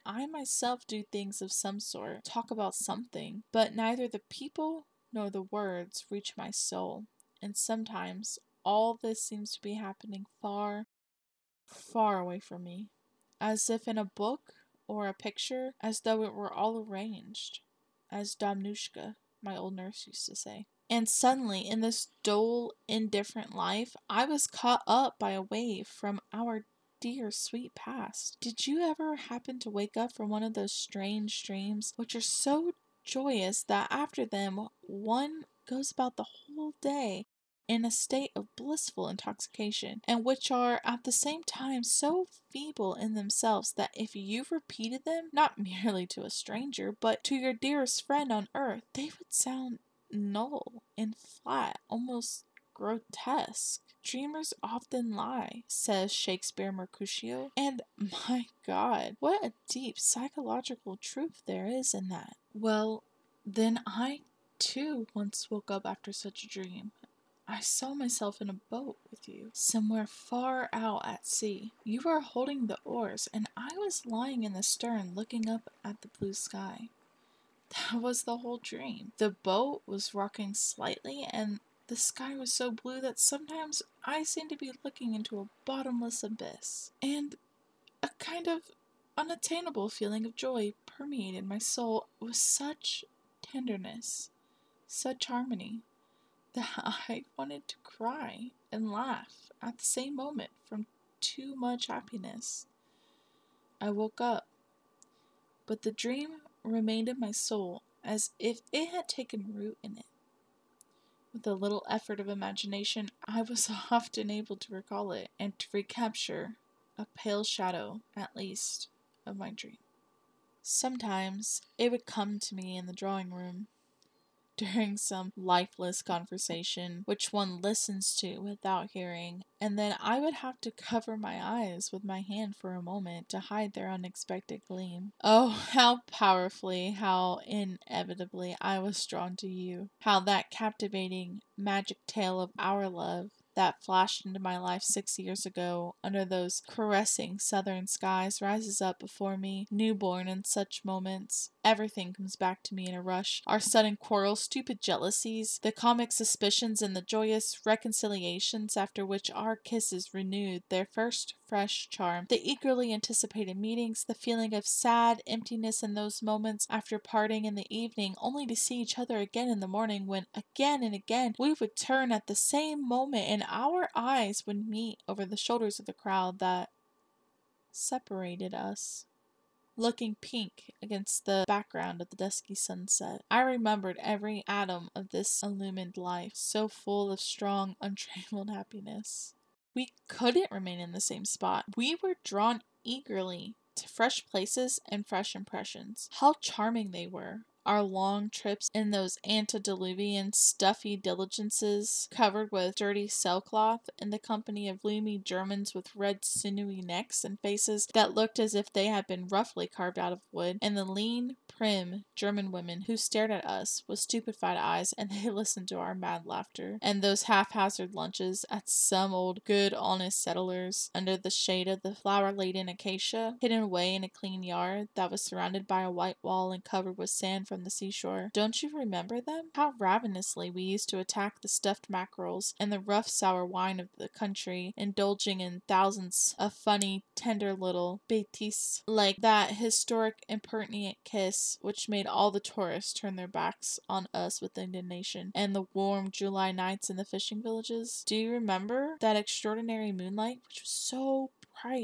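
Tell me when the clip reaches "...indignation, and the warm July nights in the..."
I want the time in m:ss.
4:04.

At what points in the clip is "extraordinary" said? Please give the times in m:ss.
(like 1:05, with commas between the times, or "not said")
4:09.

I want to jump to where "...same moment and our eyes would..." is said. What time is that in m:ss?
2:52.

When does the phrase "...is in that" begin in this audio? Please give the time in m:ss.
1:01.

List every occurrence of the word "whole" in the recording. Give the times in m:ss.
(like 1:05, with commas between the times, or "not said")
0:36, 1:18.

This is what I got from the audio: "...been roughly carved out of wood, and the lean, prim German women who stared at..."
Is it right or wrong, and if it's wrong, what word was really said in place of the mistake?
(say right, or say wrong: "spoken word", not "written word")
right.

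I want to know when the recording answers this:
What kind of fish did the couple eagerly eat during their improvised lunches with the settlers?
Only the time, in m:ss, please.
3:51.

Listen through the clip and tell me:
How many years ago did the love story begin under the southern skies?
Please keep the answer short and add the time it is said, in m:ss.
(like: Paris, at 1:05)
6, at 2:24.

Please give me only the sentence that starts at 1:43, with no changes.
I woke up, but the dream remained in my soul as if it had taken root in it.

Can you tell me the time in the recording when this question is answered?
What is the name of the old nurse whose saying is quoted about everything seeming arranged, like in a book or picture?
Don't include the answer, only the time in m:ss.
0:18.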